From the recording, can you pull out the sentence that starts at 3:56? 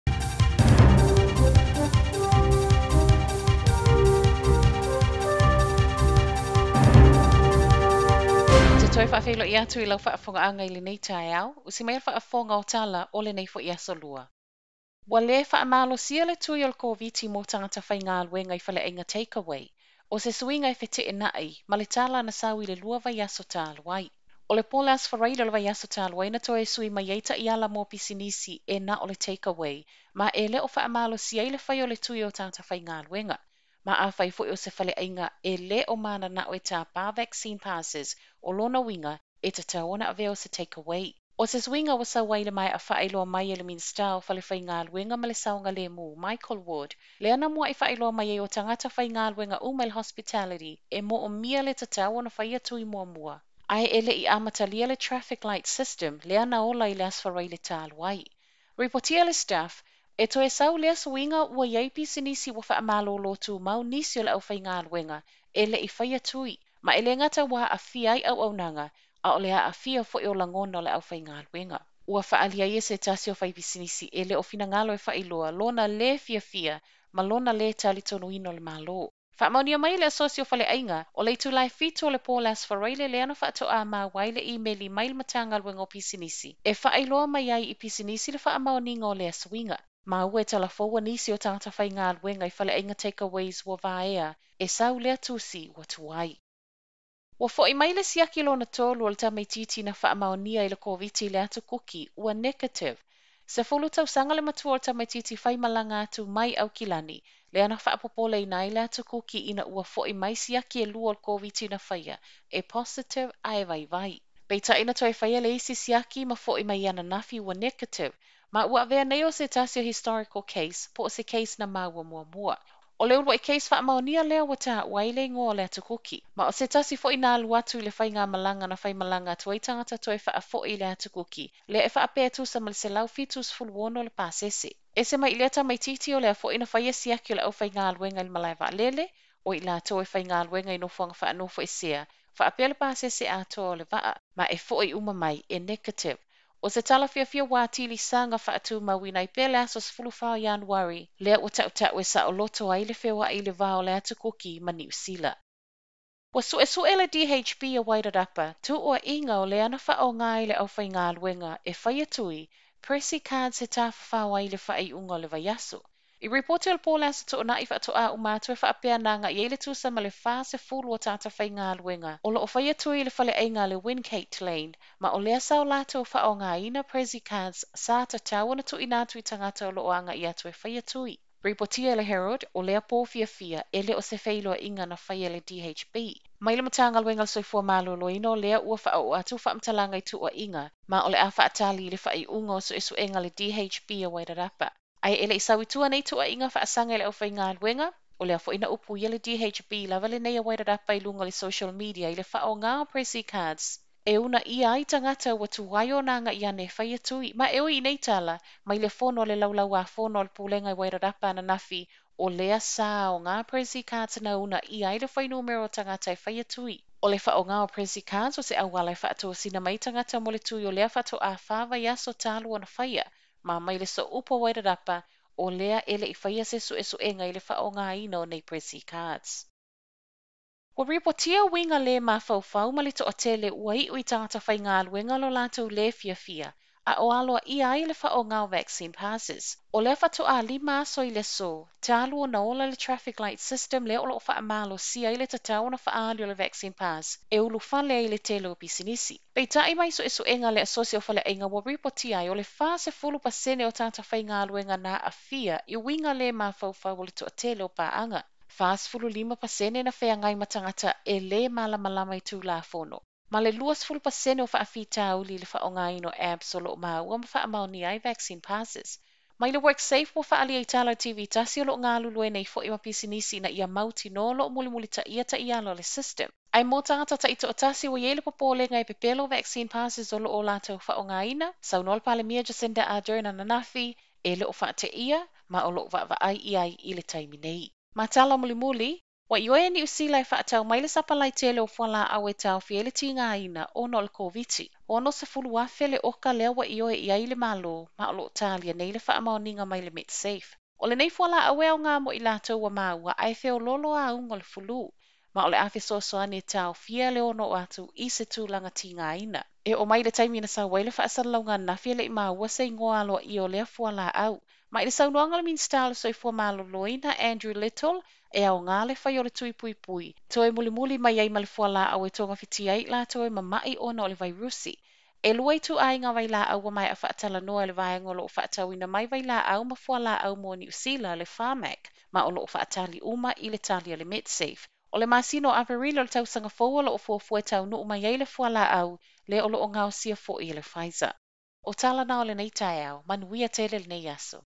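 a o alo i ai le whaonga o vaccine passes.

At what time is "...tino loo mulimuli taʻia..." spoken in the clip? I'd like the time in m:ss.
4:34.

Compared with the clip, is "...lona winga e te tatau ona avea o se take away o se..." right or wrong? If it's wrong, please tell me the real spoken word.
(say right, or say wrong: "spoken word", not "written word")
right.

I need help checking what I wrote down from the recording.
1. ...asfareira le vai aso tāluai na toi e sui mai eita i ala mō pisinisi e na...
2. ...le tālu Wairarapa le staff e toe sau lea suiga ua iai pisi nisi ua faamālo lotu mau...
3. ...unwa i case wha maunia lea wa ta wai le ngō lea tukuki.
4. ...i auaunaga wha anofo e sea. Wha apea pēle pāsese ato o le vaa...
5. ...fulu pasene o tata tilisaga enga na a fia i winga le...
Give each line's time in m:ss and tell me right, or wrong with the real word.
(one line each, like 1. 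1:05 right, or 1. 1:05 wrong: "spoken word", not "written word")
1. 0:25 right
2. 0:57 wrong: "Reportia", not "Wairarapa"
3. 2:03 right
4. 2:20 wrong: "nofuanga", not "auaunaga"
5. 4:12 wrong: "whainga", not "tilisaga".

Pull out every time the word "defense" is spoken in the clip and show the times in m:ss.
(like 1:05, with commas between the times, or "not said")
not said.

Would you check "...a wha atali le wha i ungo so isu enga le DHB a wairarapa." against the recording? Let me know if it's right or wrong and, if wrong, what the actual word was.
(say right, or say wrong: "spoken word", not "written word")
right.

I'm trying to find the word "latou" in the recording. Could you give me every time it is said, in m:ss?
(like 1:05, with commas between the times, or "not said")
4:40, 5:22.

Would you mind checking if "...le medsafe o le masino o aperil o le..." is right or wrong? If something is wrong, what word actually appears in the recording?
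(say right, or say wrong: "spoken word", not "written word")
right.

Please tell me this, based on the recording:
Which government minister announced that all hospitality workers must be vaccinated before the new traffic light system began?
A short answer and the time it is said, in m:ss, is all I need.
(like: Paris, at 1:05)
Michael Wood, at 0:46.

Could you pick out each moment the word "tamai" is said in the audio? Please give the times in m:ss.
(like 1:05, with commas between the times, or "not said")
1:39, 1:44.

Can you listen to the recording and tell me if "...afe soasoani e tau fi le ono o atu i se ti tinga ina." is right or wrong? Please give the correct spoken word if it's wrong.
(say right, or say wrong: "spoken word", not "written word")
right.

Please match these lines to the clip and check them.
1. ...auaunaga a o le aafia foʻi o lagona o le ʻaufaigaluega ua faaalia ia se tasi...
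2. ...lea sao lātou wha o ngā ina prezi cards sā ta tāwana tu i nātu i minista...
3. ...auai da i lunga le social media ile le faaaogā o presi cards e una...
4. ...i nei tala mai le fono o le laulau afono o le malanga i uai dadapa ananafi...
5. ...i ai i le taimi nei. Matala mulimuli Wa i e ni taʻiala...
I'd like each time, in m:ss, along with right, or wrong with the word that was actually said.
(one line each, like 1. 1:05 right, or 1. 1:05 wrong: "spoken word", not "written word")
1. 1:08 right
2. 2:55 wrong: "tangata", not "minista"
3. 3:20 right
4. 3:27 wrong: "pulega", not "malanga"
5. 4:46 wrong: "usila", not "taʻiala".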